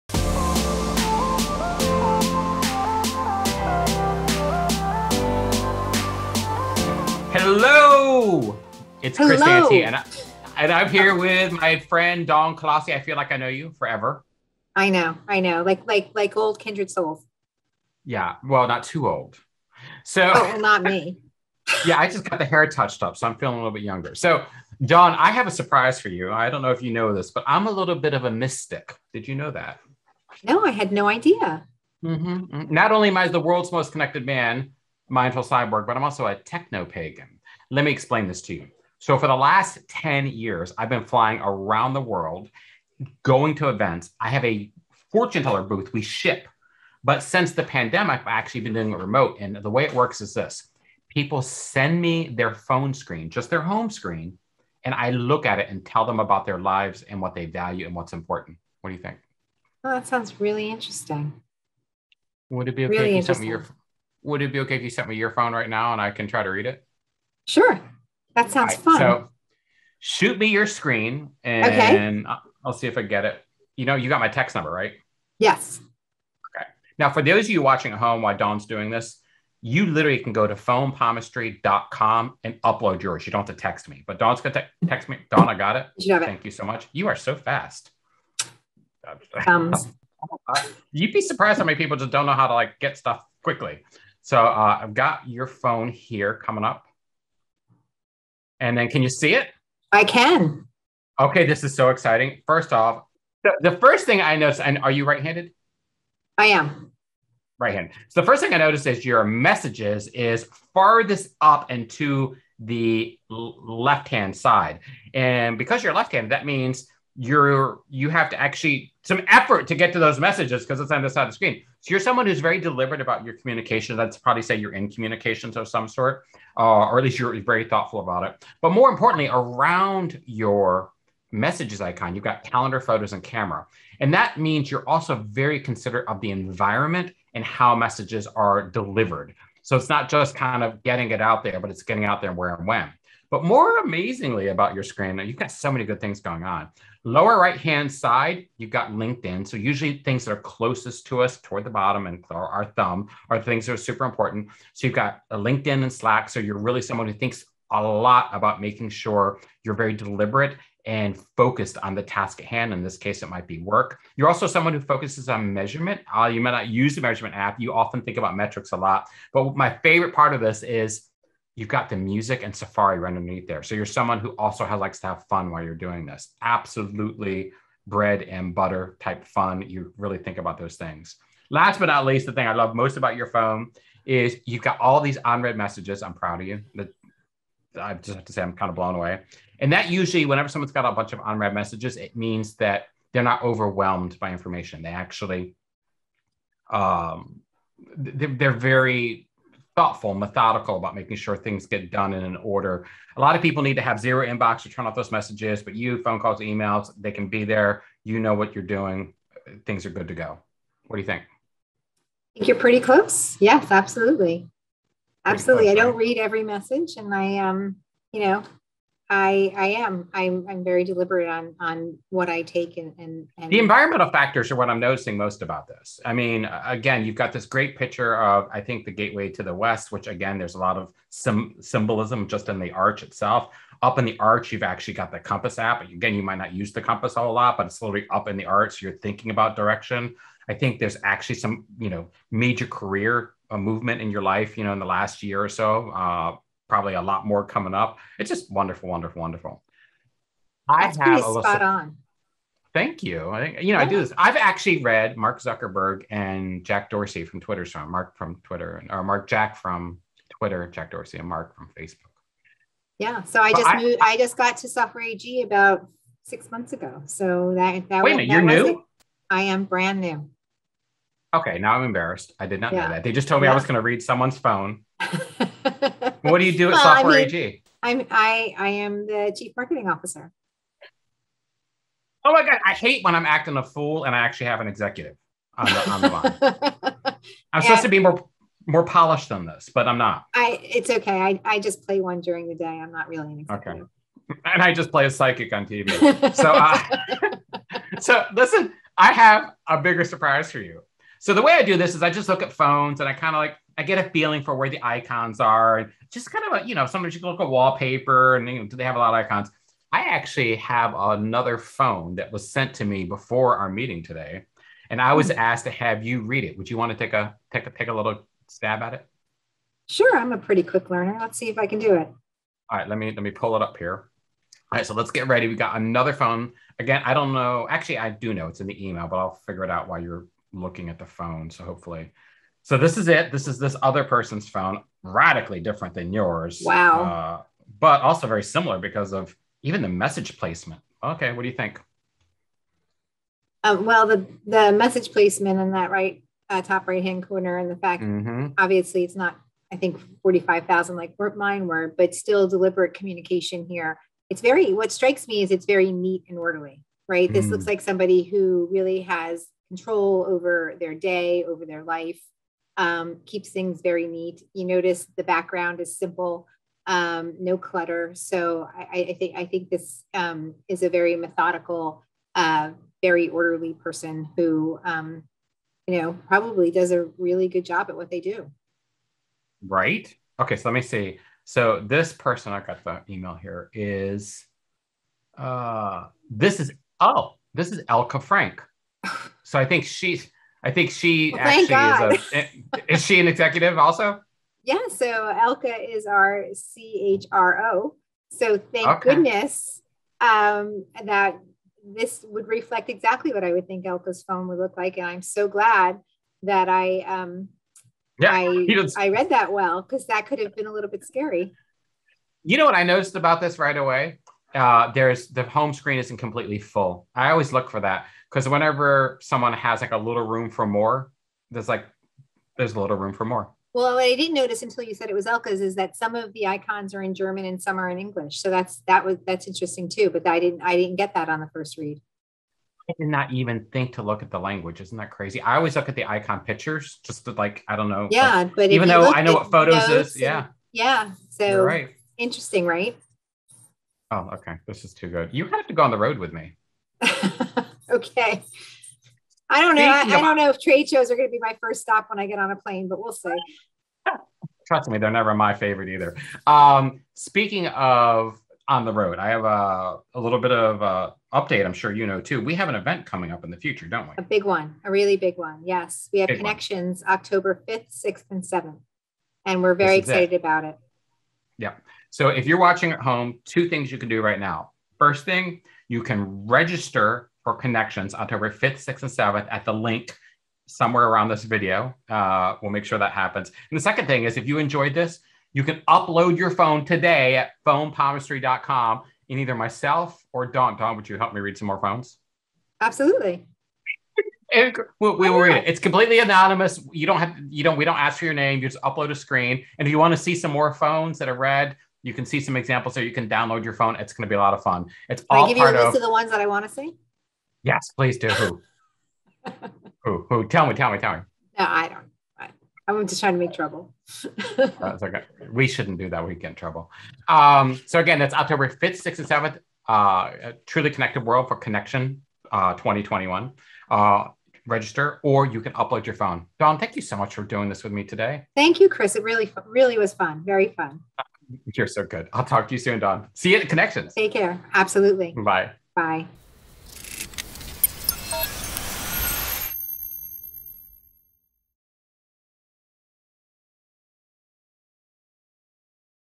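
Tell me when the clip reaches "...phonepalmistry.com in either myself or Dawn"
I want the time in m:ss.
8:07.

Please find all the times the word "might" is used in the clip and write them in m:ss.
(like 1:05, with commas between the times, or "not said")
2:43, 3:56.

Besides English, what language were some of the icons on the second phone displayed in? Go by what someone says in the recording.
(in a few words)
German.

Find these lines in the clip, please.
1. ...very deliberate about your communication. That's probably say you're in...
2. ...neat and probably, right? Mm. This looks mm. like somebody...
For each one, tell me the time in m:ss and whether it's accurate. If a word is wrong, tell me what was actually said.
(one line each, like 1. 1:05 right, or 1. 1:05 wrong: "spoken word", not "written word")
1. 2:02 right
2. 5:55 wrong: "orderly", not "probably".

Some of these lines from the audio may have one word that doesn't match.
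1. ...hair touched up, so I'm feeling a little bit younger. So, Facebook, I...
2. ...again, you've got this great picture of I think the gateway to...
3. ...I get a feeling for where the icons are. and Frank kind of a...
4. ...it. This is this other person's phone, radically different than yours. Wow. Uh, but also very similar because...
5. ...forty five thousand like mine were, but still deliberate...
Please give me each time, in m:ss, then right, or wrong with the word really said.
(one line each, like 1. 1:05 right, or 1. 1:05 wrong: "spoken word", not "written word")
1. 0:22 wrong: "Dawn", not "Facebook"
2. 3:46 right
3. 5:03 wrong: "Just", not "Frank"
4. 5:33 right
5. 5:50 right.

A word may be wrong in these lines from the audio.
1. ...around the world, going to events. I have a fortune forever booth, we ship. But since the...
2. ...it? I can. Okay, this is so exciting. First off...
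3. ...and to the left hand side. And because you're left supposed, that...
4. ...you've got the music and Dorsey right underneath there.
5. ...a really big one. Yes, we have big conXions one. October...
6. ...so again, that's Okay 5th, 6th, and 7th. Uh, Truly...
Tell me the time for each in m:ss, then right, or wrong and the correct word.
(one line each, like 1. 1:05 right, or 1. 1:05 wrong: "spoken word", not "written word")
1. 0:41 wrong: "teller", not "forever"
2. 1:39 right
3. 1:51 wrong: "handed", not "supposed"
4. 2:51 wrong: "Safari", not "Dorsey"
5. 7:44 right
6. 8:37 wrong: "October", not "Okay".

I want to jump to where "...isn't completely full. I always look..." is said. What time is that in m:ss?
6:55.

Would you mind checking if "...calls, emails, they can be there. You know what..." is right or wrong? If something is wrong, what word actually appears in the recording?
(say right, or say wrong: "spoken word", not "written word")
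right.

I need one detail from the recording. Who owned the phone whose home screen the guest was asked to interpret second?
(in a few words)
Elke Frank.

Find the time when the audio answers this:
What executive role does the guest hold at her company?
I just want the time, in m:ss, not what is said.
4:39.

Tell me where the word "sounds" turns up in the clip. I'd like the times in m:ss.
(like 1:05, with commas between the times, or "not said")
1:00, 1:08.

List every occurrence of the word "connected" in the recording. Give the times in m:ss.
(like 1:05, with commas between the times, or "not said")
0:33, 8:40.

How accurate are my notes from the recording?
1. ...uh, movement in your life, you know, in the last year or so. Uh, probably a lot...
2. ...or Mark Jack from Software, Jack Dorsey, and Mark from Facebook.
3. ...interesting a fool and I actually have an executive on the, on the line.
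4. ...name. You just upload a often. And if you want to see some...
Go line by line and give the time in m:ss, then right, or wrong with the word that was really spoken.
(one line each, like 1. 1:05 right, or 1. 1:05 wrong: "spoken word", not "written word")
1. 4:03 right
2. 4:18 wrong: "Twitter", not "Software"
3. 4:43 wrong: "acting", not "interesting"
4. 8:18 wrong: "screen", not "often".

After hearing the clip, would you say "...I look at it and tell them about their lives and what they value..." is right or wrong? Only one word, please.
right.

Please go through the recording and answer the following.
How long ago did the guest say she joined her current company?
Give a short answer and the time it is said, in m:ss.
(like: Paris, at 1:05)
About six months, at 4:25.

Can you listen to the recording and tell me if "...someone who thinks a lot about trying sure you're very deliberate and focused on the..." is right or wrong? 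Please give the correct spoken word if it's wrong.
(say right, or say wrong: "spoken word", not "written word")
wrong: "making", not "trying".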